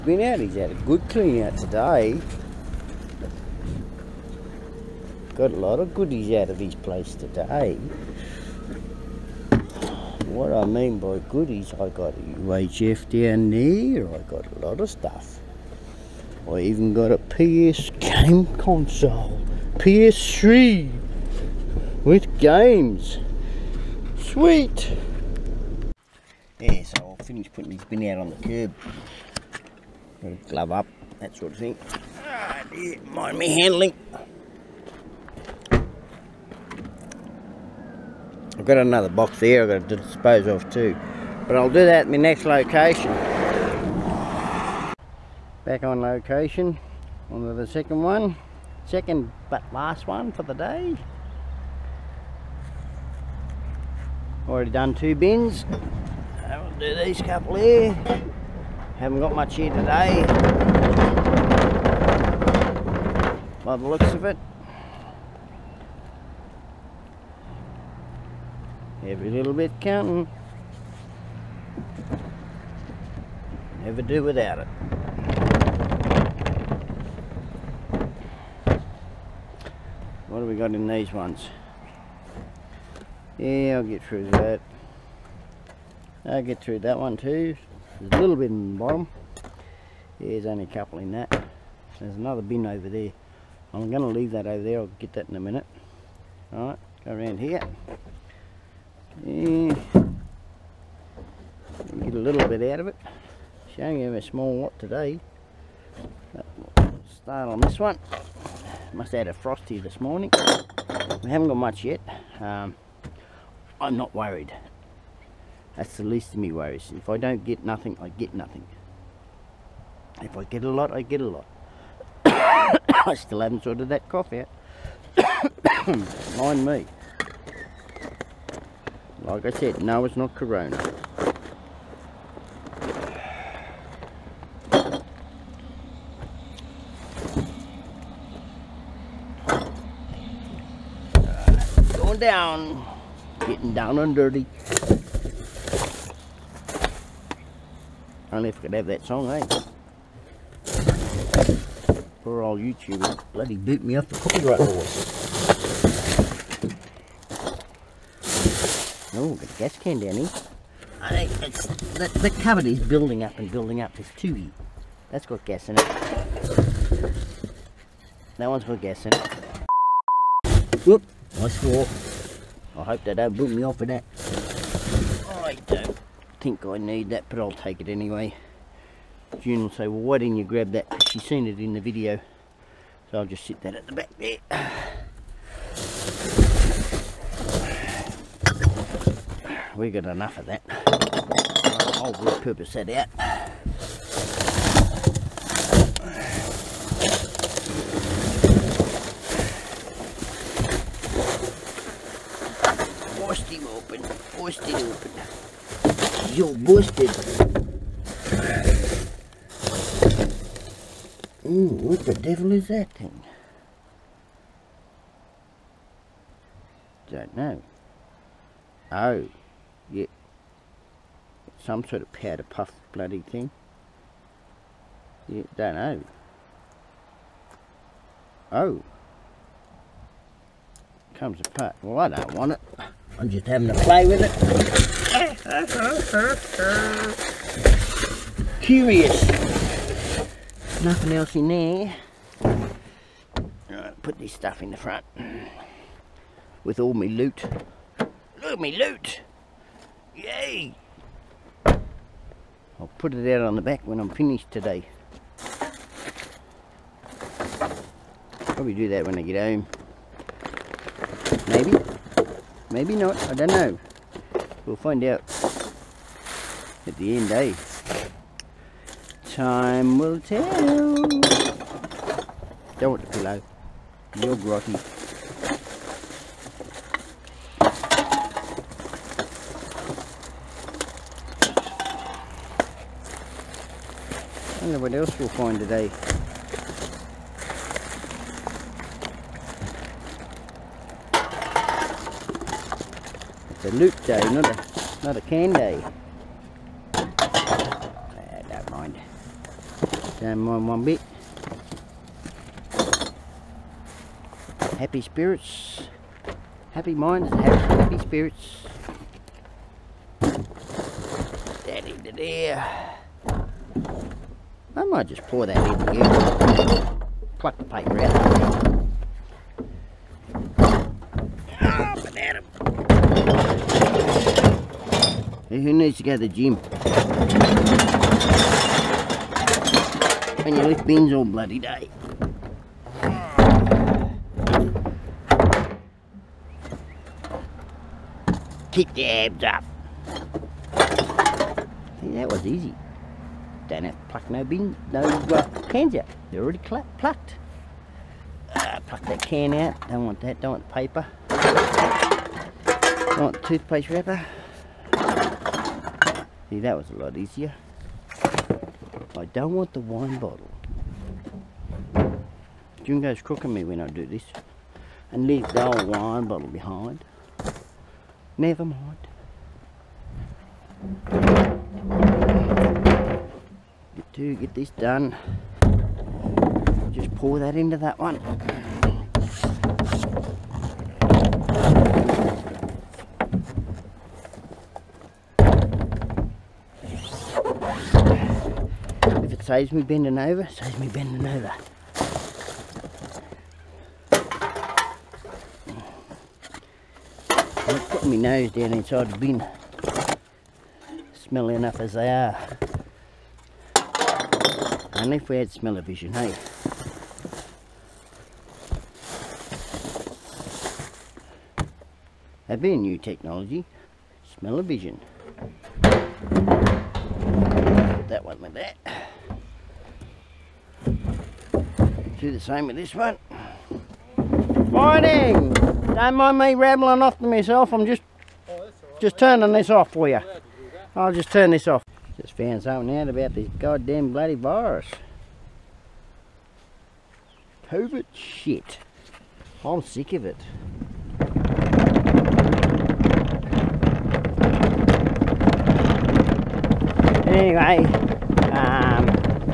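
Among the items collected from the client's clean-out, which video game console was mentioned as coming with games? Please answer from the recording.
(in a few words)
PS3.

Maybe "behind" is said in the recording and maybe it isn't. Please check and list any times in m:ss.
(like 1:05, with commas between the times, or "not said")
6:06.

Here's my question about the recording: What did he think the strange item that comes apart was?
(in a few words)
powder puff.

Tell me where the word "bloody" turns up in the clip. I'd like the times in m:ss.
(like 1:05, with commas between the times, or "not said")
2:33, 3:42, 5:31, 7:14.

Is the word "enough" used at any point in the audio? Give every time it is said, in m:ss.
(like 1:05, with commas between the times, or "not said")
3:10, 6:41.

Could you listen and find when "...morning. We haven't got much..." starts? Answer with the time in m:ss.
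1:50.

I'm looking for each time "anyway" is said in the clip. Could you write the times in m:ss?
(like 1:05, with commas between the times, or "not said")
2:57, 7:27.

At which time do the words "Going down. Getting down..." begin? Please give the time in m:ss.
2:21.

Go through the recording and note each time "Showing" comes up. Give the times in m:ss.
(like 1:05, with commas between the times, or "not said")
1:43.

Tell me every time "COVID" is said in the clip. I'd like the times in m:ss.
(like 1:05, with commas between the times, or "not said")
7:17.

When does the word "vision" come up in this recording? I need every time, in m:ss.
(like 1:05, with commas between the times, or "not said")
6:45, 6:54.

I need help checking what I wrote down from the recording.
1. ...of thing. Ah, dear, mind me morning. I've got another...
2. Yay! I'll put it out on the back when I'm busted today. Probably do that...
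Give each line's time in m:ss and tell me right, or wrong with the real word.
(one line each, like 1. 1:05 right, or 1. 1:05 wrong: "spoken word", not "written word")
1. 0:31 wrong: "handling", not "morning"
2. 4:10 wrong: "finished", not "busted".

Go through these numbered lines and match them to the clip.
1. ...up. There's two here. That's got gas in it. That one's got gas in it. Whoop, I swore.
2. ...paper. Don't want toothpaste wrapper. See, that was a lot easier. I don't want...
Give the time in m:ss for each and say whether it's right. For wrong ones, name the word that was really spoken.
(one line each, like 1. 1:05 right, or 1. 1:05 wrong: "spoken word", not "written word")
1. 2:43 right
2. 5:50 right.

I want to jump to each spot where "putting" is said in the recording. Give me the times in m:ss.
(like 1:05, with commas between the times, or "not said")
0:27, 6:37.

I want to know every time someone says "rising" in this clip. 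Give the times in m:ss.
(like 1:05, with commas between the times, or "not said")
not said.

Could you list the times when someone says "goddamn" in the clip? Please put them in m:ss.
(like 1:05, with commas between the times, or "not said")
7:13.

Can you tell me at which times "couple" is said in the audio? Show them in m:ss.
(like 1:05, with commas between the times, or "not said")
0:57, 1:30.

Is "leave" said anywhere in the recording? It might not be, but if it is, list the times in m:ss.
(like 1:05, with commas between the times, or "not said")
1:34, 6:05.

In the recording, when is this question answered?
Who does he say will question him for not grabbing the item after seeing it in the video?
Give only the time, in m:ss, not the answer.
2:59.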